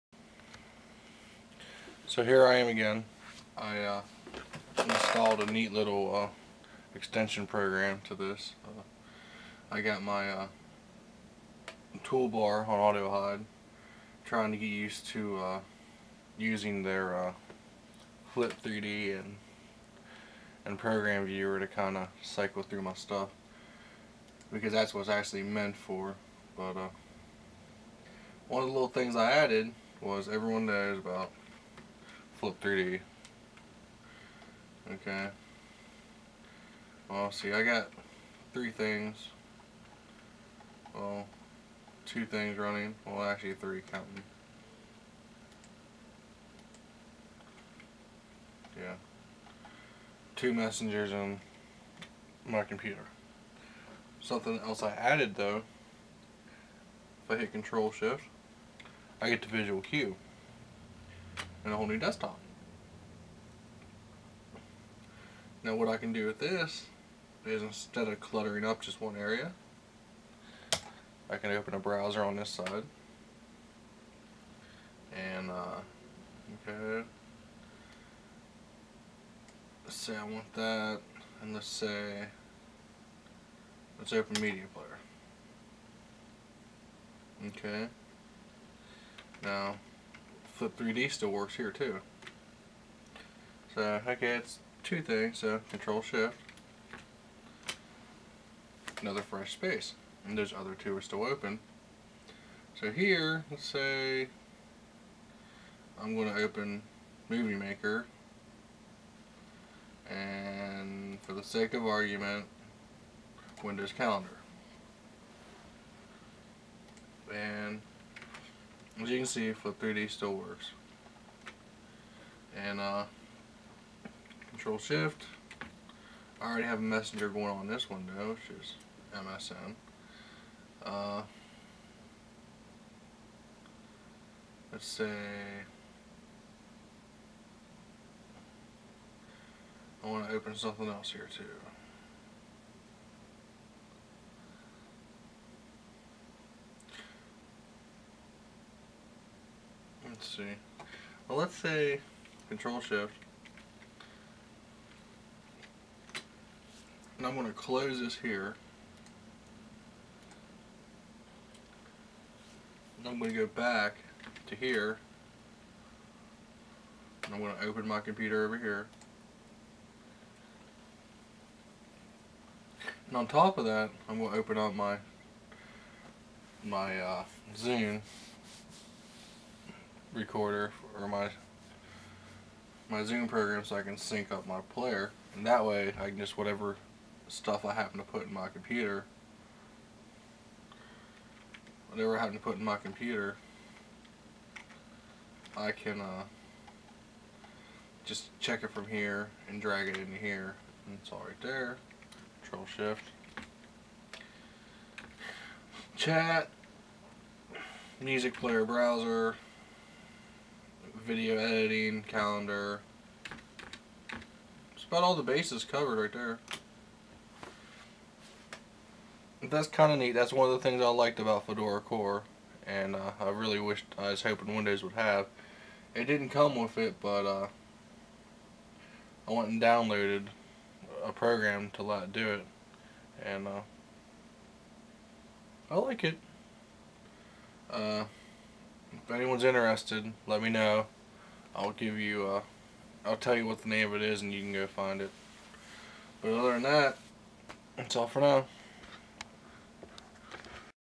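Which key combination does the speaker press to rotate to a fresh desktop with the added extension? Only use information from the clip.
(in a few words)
Control-Shift.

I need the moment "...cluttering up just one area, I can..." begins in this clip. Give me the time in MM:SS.
01:08.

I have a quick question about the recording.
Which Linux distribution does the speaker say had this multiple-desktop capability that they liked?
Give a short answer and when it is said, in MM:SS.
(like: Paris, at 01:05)
Fedora Core, at 03:41.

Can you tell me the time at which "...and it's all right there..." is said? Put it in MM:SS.
03:20.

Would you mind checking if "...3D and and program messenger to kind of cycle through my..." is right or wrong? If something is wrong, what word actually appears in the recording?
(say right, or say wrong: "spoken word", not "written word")
wrong: "viewer", not "messenger".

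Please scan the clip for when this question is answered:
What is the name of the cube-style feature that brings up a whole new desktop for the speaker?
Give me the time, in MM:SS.
00:59.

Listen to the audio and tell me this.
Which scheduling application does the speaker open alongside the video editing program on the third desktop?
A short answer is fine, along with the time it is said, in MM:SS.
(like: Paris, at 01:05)
Windows Calendar, at 01:53.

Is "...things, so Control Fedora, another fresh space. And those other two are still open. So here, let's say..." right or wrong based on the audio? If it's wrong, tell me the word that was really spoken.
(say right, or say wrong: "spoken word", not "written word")
wrong: "Shift", not "Fedora".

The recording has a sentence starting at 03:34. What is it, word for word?
It's about all the bases covered right there.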